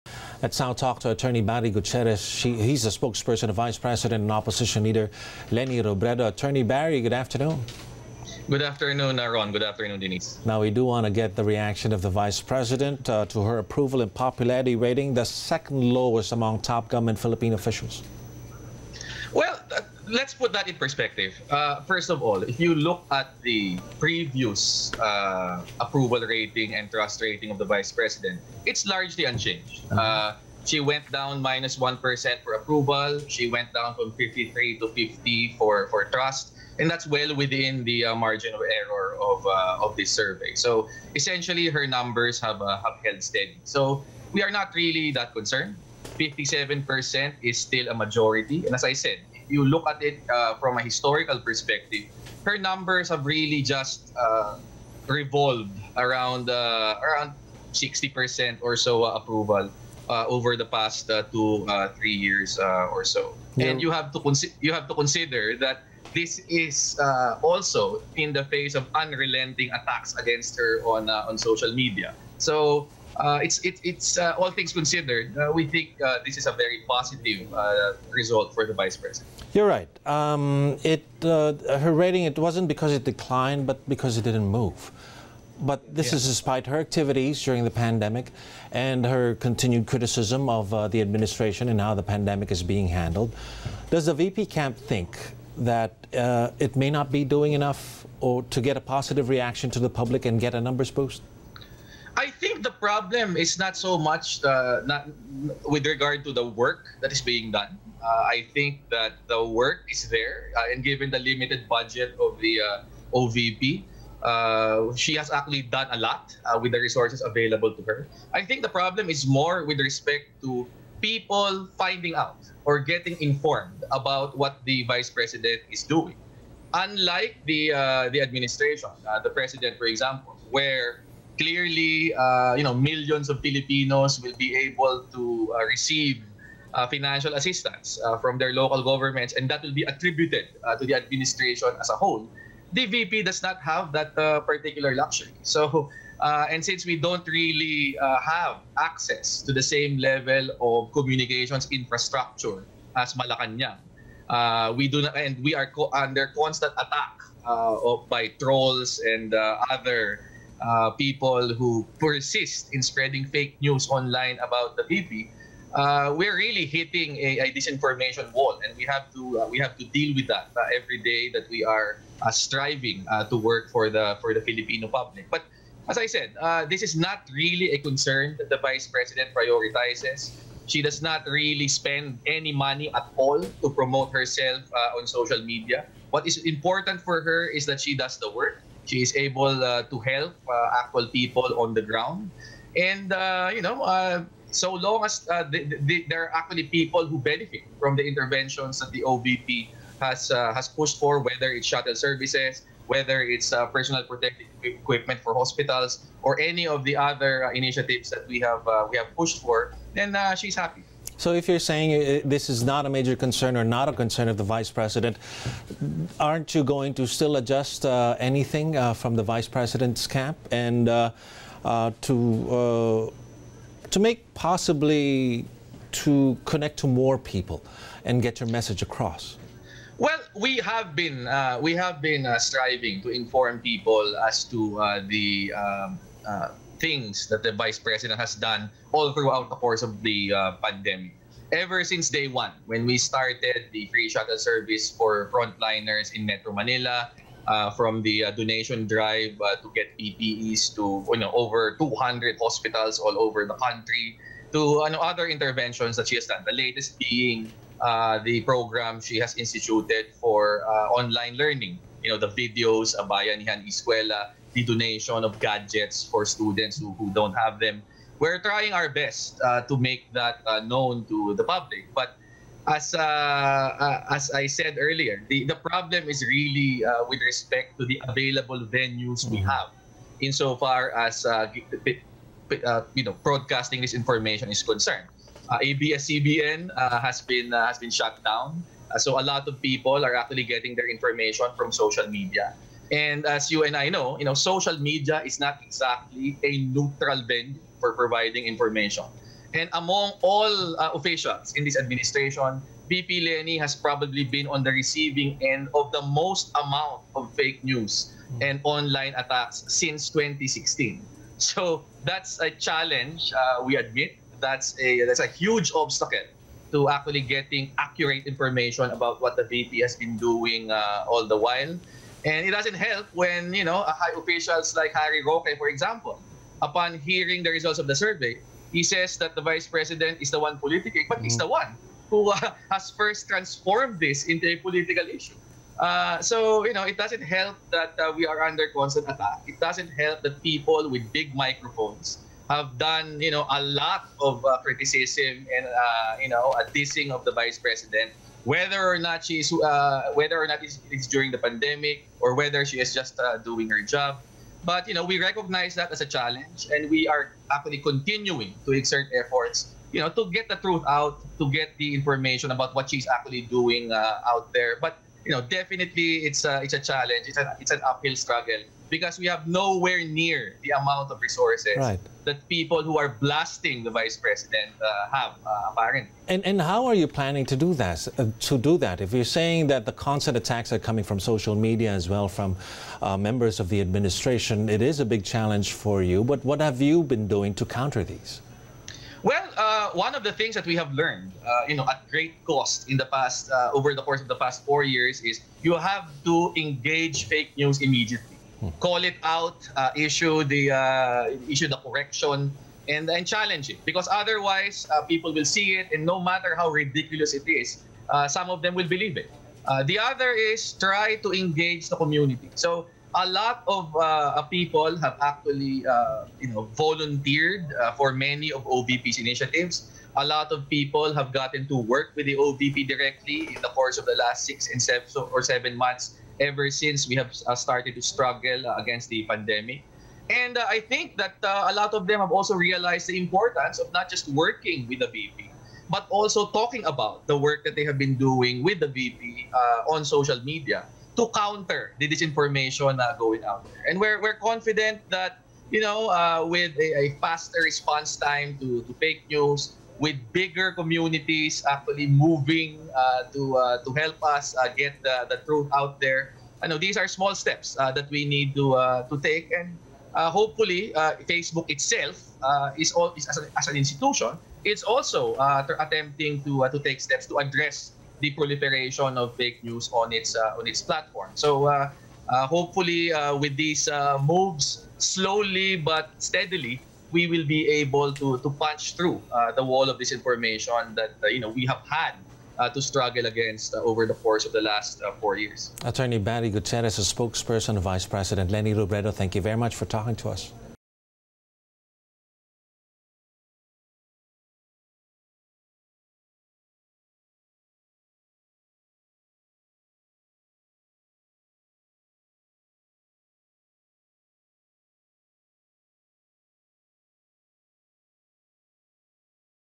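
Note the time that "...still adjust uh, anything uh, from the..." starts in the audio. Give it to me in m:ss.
3:37.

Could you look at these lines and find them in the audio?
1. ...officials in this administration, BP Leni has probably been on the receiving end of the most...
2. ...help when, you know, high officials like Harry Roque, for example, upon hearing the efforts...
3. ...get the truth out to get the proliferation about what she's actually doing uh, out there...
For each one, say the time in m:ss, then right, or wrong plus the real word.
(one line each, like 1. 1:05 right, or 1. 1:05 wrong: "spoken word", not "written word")
1. 5:00 right
2. 5:22 wrong: "results", not "efforts"
3. 6:00 wrong: "information", not "proliferation".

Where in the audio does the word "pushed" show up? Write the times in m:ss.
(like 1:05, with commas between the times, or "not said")
3:20, 3:29.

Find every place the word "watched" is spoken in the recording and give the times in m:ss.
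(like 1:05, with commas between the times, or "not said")
not said.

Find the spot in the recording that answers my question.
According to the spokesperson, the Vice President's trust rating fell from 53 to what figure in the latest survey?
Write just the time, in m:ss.
0:34.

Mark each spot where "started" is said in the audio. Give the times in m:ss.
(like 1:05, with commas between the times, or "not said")
4:02, 7:07.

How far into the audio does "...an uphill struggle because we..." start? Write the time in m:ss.
6:07.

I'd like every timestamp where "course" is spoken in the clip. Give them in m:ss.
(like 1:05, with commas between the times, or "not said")
3:59, 6:34, 7:03, 8:04.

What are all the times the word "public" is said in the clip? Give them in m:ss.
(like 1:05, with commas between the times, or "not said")
1:39, 2:54, 4:31.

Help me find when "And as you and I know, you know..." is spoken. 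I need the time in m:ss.
4:52.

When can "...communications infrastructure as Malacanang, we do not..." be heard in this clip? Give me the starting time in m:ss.
2:30.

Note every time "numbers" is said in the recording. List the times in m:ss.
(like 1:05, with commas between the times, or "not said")
0:41, 0:52, 1:40.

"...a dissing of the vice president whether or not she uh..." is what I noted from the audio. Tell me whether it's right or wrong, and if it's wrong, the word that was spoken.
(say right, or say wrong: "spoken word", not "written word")
right.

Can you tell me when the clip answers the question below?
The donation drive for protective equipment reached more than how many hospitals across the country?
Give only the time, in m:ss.
4:11.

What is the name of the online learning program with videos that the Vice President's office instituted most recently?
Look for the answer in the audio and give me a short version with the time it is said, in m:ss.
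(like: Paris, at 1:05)
Abayanihan Escuela, at 4:22.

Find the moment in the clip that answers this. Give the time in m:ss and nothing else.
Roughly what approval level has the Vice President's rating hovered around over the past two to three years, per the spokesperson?
0:57.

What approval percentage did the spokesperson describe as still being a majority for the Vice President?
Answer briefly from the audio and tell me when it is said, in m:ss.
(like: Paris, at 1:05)
57%, at 0:46.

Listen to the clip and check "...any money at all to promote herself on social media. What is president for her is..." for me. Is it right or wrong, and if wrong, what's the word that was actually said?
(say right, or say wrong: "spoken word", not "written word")
wrong: "important", not "president".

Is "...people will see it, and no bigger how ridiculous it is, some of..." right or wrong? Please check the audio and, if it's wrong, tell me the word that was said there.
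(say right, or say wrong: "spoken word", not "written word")
wrong: "matter", not "bigger".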